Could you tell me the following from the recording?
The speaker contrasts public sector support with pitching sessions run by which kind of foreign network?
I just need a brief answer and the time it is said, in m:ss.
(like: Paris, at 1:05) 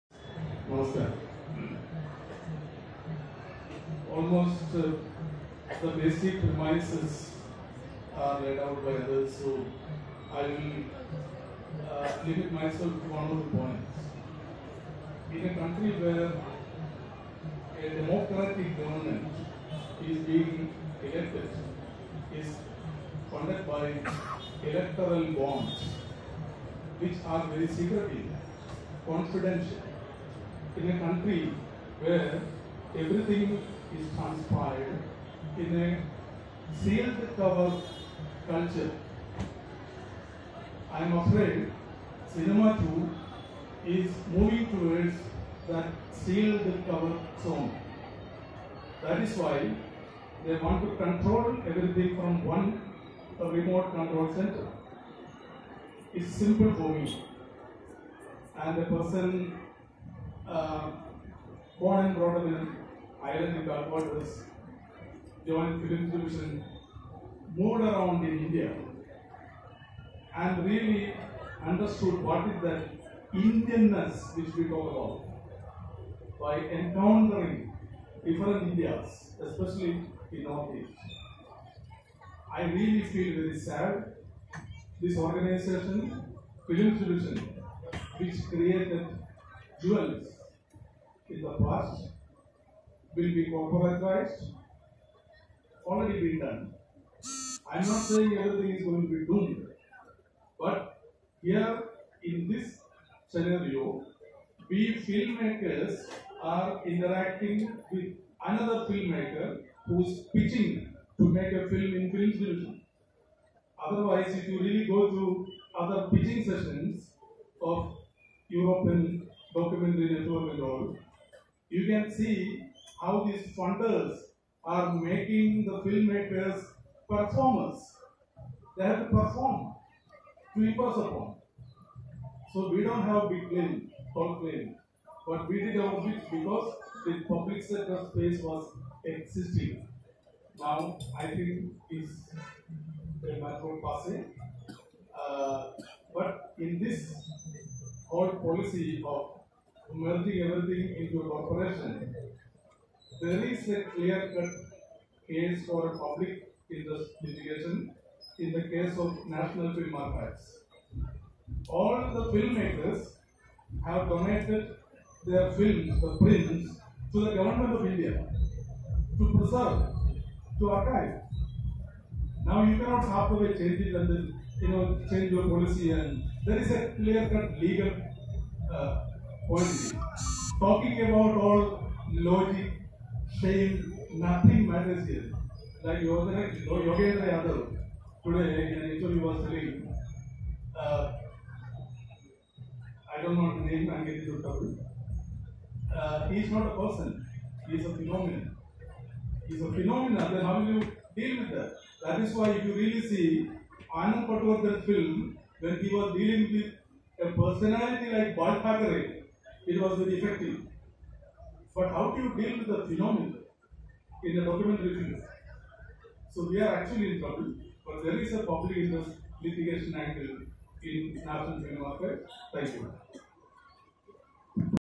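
European documentary network, at 1:58.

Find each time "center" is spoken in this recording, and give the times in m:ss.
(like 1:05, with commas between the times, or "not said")
0:54.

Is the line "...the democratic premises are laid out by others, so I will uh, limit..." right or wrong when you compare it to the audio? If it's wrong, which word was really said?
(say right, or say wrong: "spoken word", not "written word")
wrong: "basic", not "democratic".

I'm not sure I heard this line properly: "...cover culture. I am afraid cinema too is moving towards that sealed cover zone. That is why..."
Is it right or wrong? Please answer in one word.
right.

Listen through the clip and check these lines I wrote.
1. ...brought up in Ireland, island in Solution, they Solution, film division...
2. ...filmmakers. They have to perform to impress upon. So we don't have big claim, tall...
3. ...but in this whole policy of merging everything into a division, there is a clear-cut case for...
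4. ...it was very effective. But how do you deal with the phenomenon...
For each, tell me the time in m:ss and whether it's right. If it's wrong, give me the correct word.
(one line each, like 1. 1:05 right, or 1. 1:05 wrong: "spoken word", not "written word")
1. 1:02 wrong: "Barbados", not "Solution"
2. 2:07 wrong: "performers", not "filmmakers"
3. 2:26 wrong: "corporation", not "division"
4. 3:29 right.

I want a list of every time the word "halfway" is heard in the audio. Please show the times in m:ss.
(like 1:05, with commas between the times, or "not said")
2:53.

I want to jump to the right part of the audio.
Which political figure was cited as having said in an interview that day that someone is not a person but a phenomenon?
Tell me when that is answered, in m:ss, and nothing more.
3:05.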